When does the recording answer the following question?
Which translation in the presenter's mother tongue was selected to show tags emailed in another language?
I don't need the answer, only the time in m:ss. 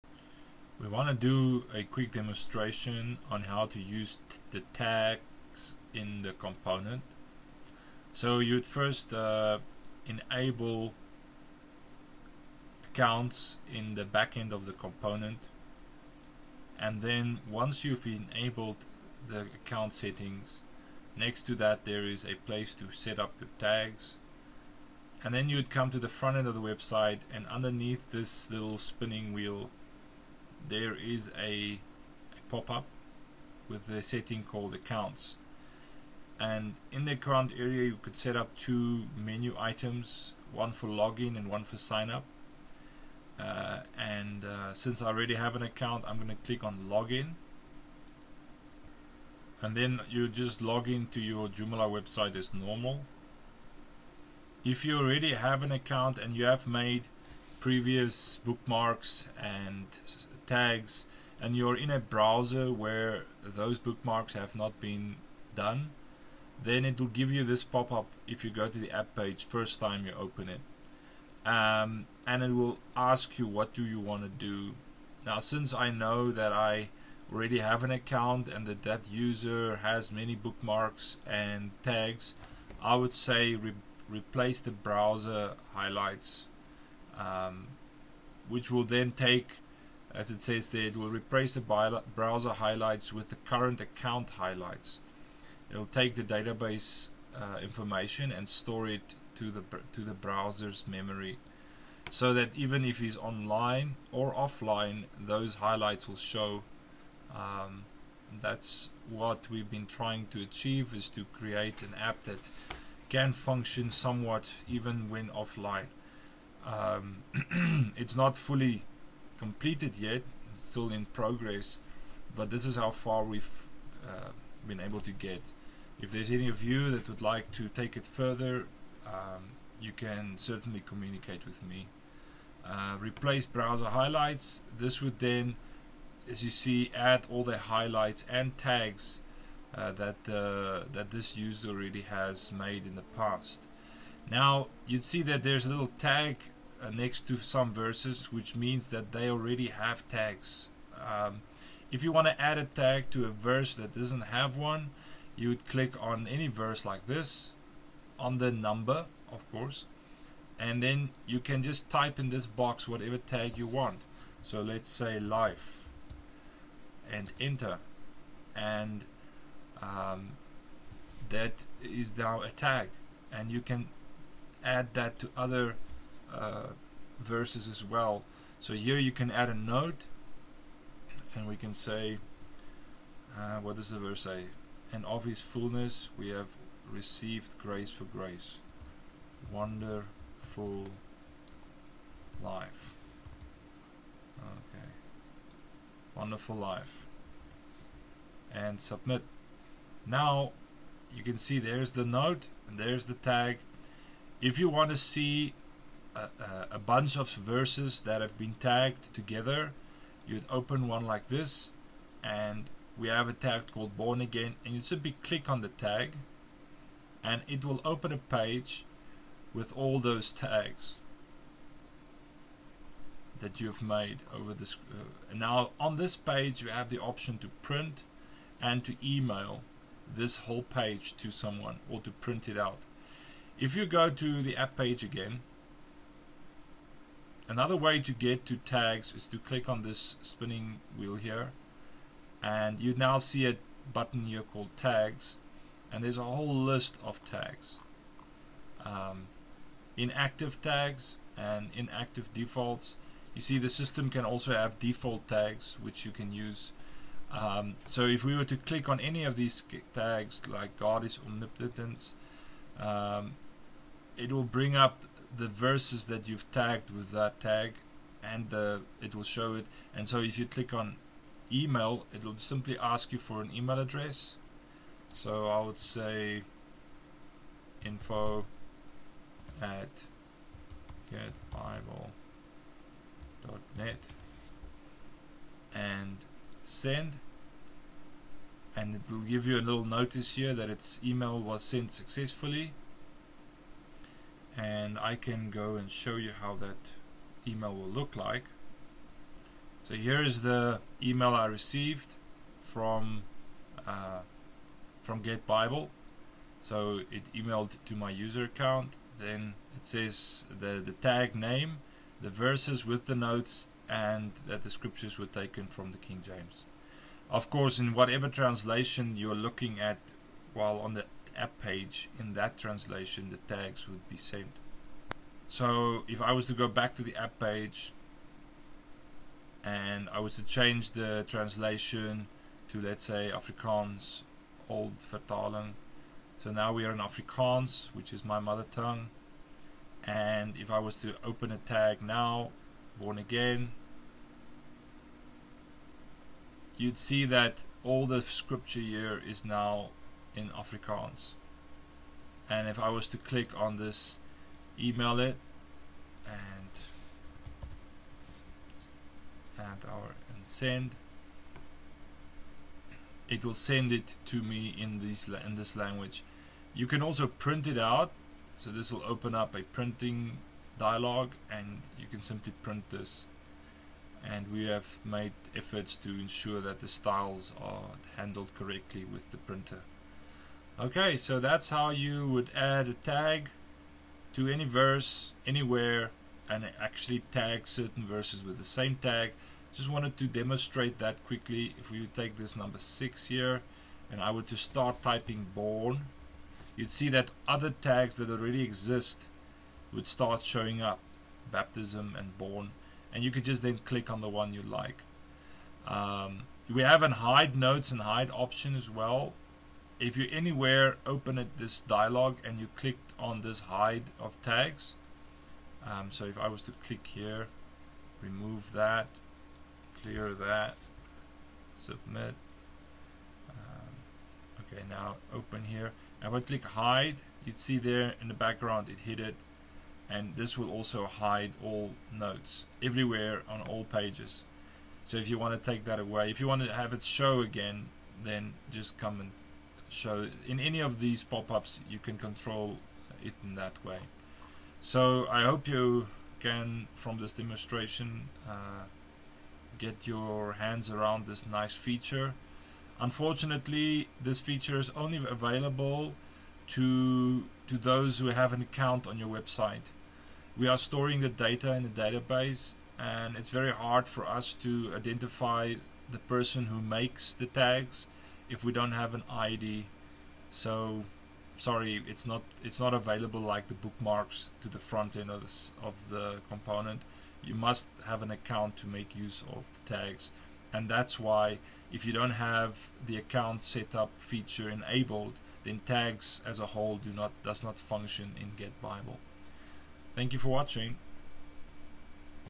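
5:33.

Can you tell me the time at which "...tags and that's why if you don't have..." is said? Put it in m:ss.
7:59.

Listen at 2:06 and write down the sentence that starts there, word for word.
If there's any of you that would like to take it further, um, you can certainly communicate with me.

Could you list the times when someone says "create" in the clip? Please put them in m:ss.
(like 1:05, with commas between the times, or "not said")
1:51.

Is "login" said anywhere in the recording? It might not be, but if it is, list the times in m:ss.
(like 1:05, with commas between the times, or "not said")
0:40, 0:46.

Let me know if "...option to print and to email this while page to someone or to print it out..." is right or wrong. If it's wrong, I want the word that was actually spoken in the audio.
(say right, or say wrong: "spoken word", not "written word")
wrong: "whole", not "while".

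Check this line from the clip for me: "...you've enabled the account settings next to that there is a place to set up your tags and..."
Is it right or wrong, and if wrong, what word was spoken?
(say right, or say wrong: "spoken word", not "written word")
right.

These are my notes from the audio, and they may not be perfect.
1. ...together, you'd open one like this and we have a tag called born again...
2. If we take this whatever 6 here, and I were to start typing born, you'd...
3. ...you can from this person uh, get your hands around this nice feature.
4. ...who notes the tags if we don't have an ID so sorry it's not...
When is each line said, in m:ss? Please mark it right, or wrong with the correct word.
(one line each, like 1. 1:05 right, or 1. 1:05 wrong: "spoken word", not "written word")
1. 3:29 right
2. 6:31 wrong: "number", not "whatever"
3. 7:25 wrong: "demonstration", not "person"
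4. 7:46 wrong: "makes", not "notes".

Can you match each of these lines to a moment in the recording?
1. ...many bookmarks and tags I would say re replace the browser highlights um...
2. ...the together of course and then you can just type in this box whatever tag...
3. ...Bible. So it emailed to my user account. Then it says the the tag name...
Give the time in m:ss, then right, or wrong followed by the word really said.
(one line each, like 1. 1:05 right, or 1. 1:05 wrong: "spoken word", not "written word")
1. 1:20 right
2. 2:38 wrong: "number", not "together"
3. 5:05 right.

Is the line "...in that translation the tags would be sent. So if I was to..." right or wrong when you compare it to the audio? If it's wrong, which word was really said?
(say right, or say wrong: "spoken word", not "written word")
right.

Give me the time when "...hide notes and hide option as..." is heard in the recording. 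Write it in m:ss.
6:47.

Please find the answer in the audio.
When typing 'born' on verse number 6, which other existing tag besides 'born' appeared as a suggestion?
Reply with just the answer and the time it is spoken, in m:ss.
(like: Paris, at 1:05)
baptism, at 6:41.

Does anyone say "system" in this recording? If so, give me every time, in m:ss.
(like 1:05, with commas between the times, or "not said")
4:13.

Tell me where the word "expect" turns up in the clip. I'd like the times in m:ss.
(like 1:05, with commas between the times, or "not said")
not said.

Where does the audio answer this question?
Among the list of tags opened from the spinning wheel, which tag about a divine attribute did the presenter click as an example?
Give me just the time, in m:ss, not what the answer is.
4:20.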